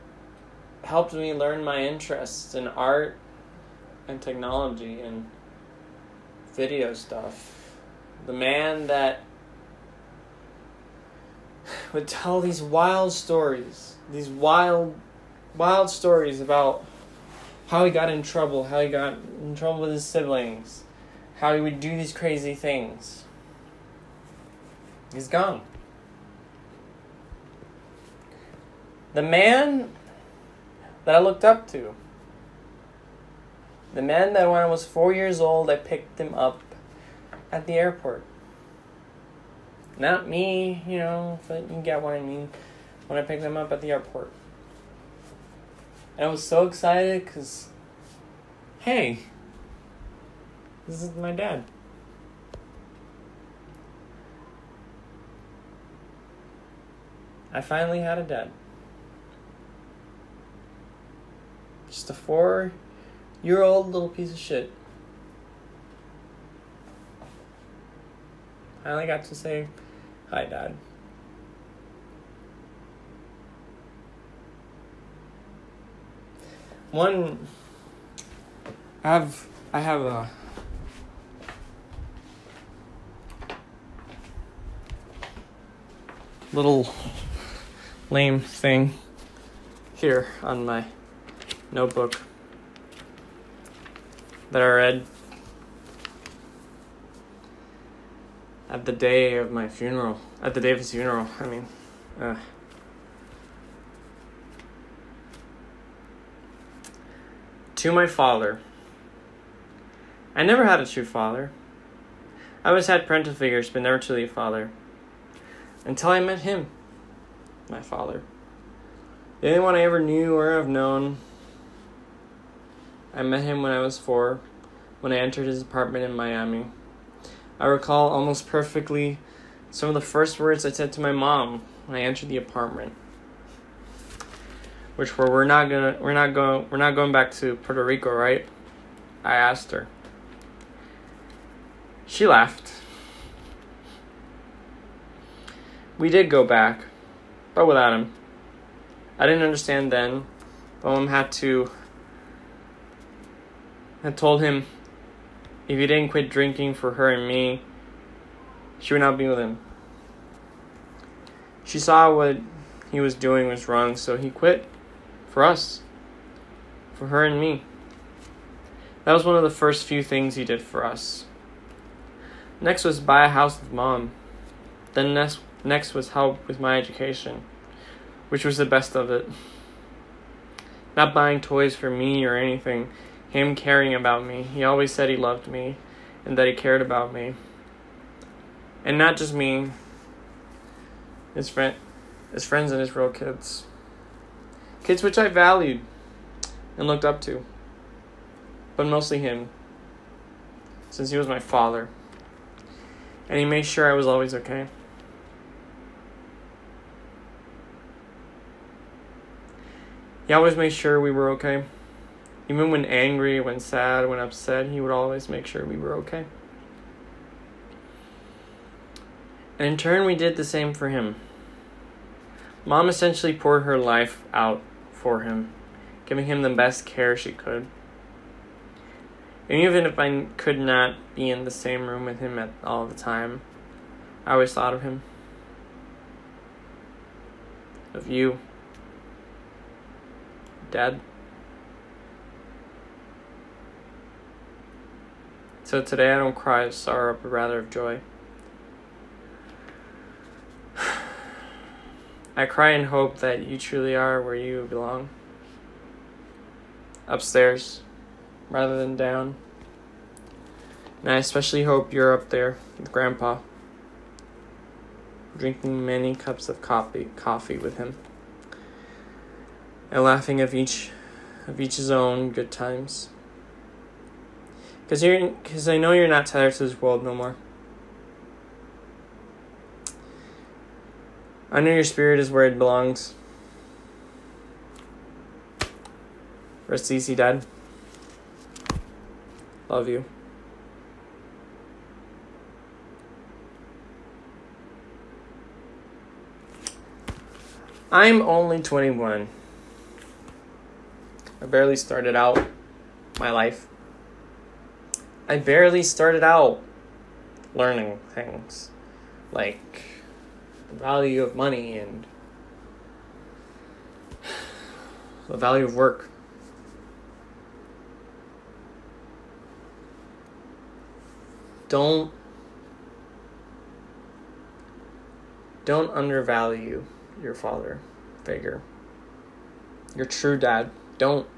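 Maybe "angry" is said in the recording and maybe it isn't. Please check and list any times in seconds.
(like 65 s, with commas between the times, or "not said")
212 s.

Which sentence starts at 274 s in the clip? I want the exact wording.
Cause you're, cause I know you're not tired to this world no more.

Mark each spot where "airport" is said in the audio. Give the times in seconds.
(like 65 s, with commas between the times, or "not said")
37 s, 43 s.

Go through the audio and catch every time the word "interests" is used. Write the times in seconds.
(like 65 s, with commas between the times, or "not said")
1 s.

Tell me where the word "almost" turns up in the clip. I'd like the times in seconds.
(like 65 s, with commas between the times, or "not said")
128 s.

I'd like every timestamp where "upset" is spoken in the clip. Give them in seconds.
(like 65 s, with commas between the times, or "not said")
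214 s.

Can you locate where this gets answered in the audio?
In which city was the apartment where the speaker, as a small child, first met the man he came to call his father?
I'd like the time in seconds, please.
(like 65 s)
126 s.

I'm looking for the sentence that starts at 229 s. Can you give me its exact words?
And even if I could not be in the same room with him at all the time, I always thought of him.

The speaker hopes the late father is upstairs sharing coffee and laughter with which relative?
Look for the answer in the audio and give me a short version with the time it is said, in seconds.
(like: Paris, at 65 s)
Grandpa, at 262 s.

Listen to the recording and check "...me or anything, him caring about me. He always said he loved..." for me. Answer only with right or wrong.
right.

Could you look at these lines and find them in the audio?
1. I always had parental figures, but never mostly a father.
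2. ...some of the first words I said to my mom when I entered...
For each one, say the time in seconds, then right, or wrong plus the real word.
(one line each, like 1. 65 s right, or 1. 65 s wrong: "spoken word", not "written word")
1. 112 s wrong: "truly", not "mostly"
2. 129 s right.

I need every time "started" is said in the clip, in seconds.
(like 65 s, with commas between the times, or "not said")
301 s, 305 s.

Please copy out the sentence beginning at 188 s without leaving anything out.
And not just me, his friend his friends and his real kids.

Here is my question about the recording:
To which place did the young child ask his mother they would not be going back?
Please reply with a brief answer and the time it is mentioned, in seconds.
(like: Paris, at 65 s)
Puerto Rico, at 137 s.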